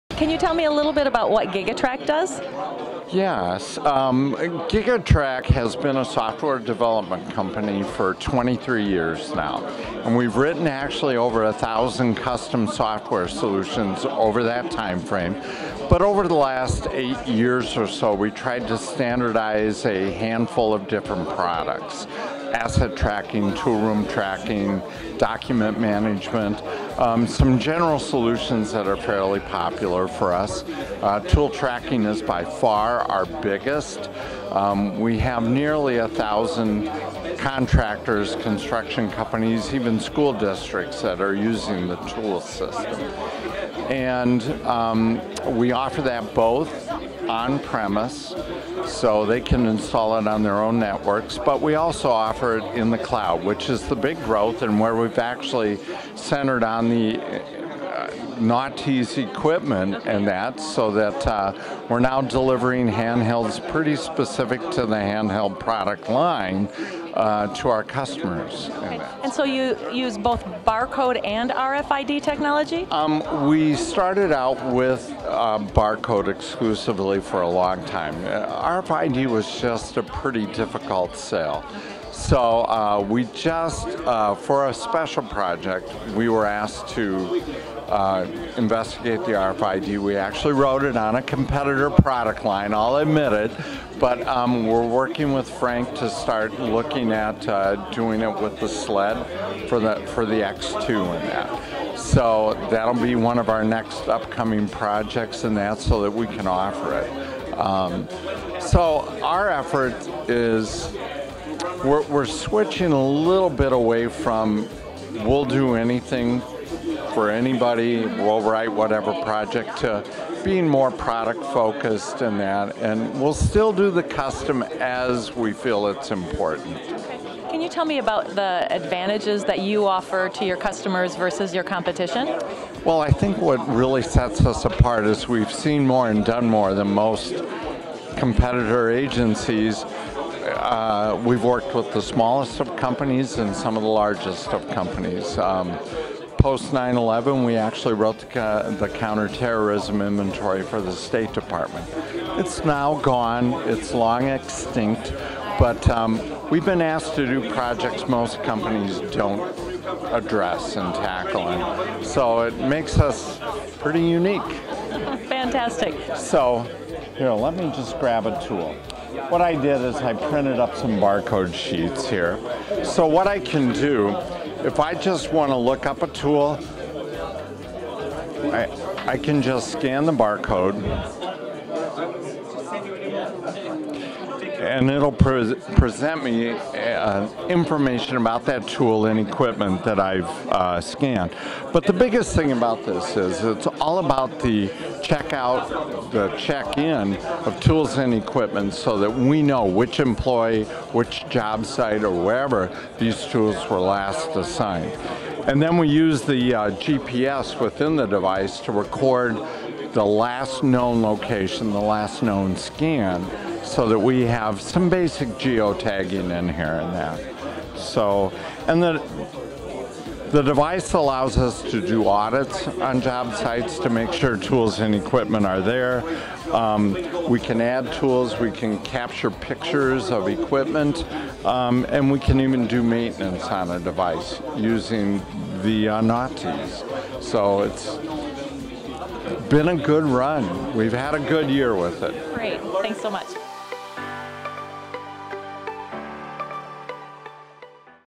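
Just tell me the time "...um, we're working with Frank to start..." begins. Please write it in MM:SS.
01:34.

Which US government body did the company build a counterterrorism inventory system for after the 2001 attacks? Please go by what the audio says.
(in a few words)
State Department.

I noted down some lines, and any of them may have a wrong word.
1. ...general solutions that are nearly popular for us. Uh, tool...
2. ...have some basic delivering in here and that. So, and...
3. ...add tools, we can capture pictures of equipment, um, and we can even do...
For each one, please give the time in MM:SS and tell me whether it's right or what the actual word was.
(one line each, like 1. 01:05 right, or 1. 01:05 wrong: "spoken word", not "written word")
1. 00:27 wrong: "fairly", not "nearly"
2. 03:34 wrong: "geotagging", not "delivering"
3. 03:47 right.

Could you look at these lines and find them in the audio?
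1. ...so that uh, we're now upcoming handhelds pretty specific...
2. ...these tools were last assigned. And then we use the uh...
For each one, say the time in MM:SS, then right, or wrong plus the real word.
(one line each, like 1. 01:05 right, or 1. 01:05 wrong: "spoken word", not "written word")
1. 01:00 wrong: "delivering", not "upcoming"
2. 03:22 right.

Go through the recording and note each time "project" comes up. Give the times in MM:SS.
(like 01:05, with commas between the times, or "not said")
01:25, 01:44, 01:59, 02:37.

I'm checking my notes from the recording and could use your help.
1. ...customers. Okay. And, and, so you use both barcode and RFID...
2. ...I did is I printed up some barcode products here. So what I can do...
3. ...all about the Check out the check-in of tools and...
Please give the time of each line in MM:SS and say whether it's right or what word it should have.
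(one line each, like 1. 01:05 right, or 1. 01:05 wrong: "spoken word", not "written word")
1. 01:07 right
2. 02:49 wrong: "sheets", not "products"
3. 03:13 right.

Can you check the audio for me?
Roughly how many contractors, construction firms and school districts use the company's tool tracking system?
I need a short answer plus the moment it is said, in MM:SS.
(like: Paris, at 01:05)
nearly 1,000, at 00:35.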